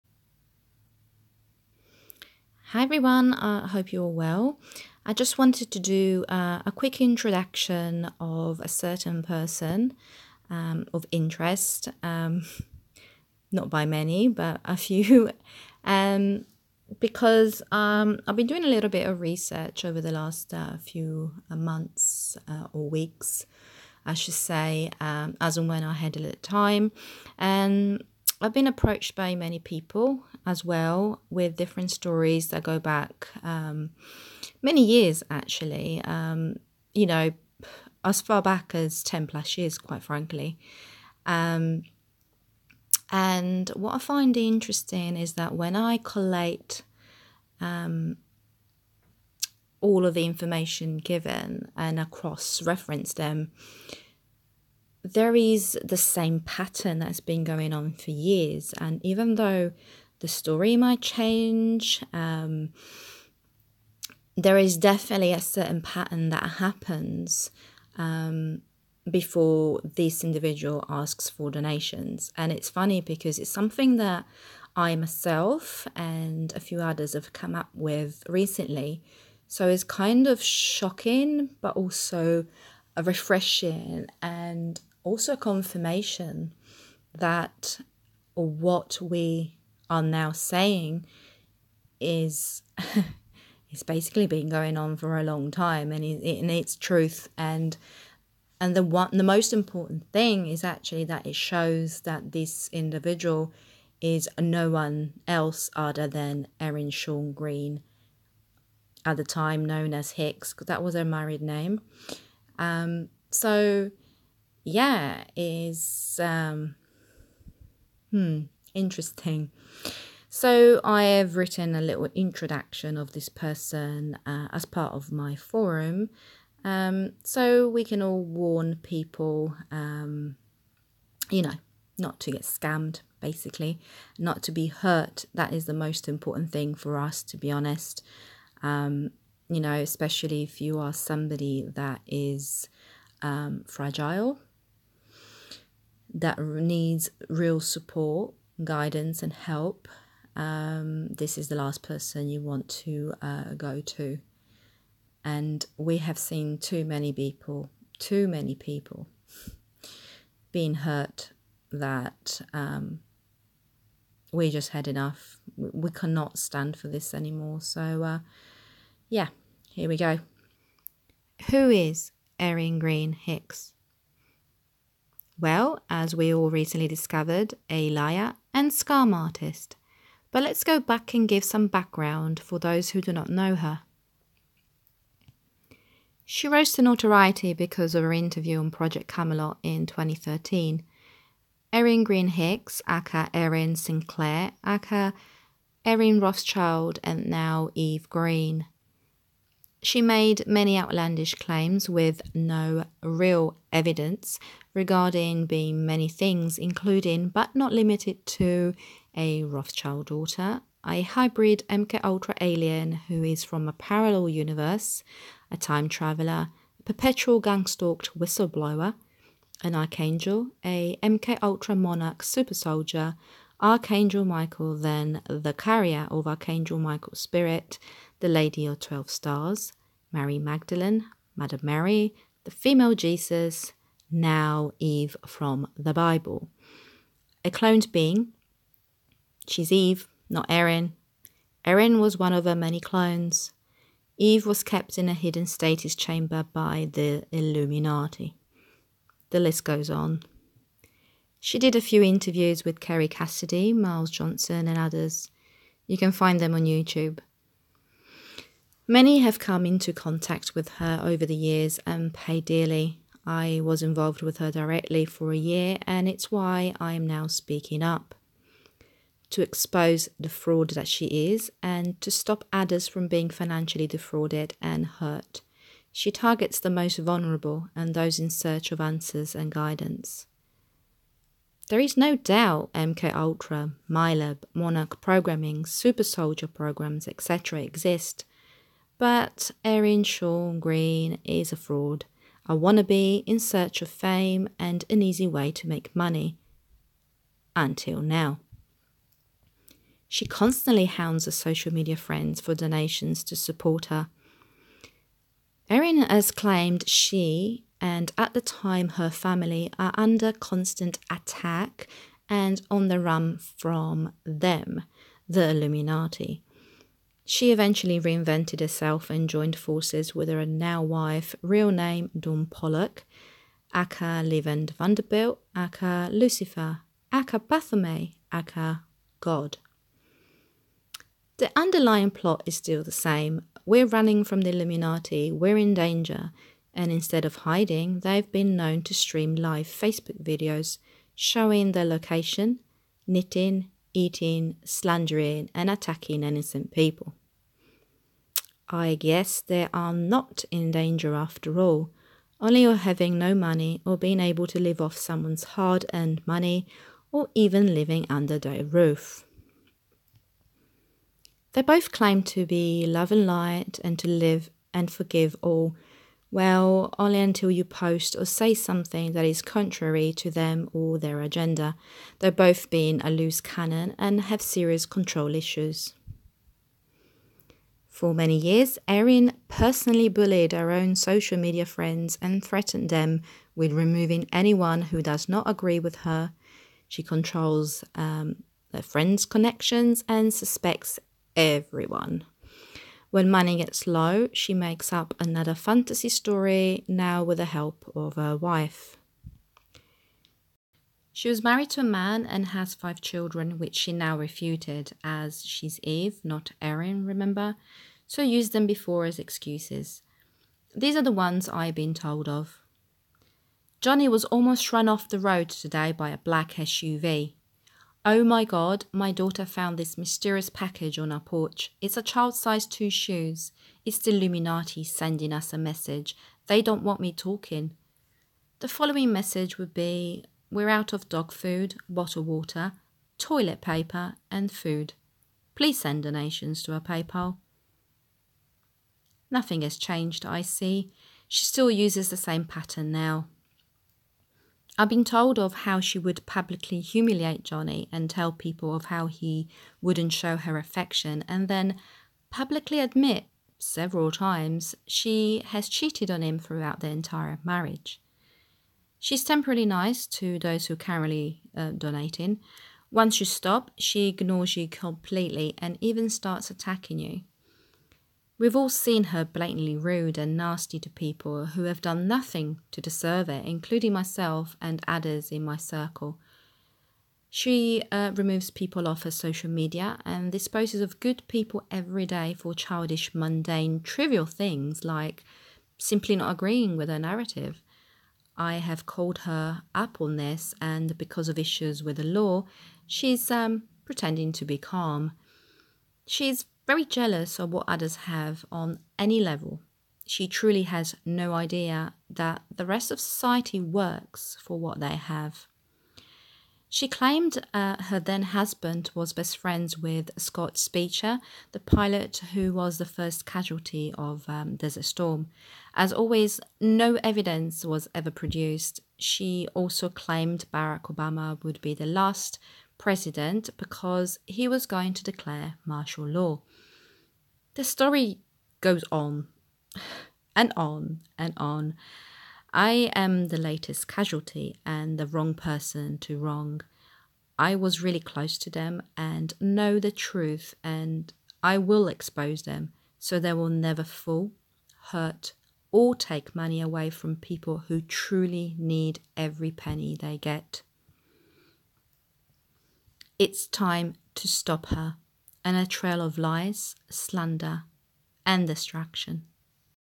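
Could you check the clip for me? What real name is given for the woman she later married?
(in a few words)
Dawn Pollock.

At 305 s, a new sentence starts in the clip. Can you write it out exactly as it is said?
Erin has claimed she and at the time, her family are under constant attack and on the run from them, the Illuminati.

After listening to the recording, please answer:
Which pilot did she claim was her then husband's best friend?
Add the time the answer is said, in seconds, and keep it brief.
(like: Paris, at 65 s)
Scott Speicher, at 510 s.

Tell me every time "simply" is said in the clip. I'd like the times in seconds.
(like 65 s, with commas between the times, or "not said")
485 s.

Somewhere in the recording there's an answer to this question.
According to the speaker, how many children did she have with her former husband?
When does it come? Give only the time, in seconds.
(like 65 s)
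402 s.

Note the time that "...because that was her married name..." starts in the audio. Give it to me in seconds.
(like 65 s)
110 s.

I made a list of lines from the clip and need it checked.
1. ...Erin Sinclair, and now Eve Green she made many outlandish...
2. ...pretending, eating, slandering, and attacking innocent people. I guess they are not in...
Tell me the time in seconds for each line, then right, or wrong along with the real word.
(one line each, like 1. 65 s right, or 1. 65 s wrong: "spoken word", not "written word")
1. 195 s wrong: "Rothschild", not "Sinclair"
2. 343 s wrong: "knitting", not "pretending".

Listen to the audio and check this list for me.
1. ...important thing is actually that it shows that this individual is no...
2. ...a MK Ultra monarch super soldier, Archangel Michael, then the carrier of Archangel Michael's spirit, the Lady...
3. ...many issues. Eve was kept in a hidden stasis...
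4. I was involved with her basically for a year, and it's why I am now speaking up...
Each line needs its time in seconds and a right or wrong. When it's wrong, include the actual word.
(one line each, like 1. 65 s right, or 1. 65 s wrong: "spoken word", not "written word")
1. 99 s right
2. 220 s right
3. 242 s wrong: "clones", not "issues"
4. 263 s wrong: "directly", not "basically".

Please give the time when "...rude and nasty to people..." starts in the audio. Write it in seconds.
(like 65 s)
469 s.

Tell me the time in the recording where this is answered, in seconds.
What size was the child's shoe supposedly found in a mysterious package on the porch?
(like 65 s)
422 s.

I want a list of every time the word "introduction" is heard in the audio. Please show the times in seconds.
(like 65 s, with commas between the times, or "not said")
7 s, 122 s.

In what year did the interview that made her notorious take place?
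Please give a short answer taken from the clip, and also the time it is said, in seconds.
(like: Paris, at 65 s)
2013, at 189 s.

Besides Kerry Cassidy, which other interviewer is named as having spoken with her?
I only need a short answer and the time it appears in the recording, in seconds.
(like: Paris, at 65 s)
Miles Johnston, at 253 s.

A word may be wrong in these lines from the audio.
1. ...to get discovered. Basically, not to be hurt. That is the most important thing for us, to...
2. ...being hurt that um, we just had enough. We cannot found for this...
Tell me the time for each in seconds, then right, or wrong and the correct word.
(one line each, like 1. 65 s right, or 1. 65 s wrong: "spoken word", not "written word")
1. 132 s wrong: "scammed", not "discovered"
2. 160 s wrong: "stand", not "found".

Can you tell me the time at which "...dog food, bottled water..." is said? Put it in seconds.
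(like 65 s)
431 s.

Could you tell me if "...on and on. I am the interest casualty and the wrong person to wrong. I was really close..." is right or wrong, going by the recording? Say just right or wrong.
wrong.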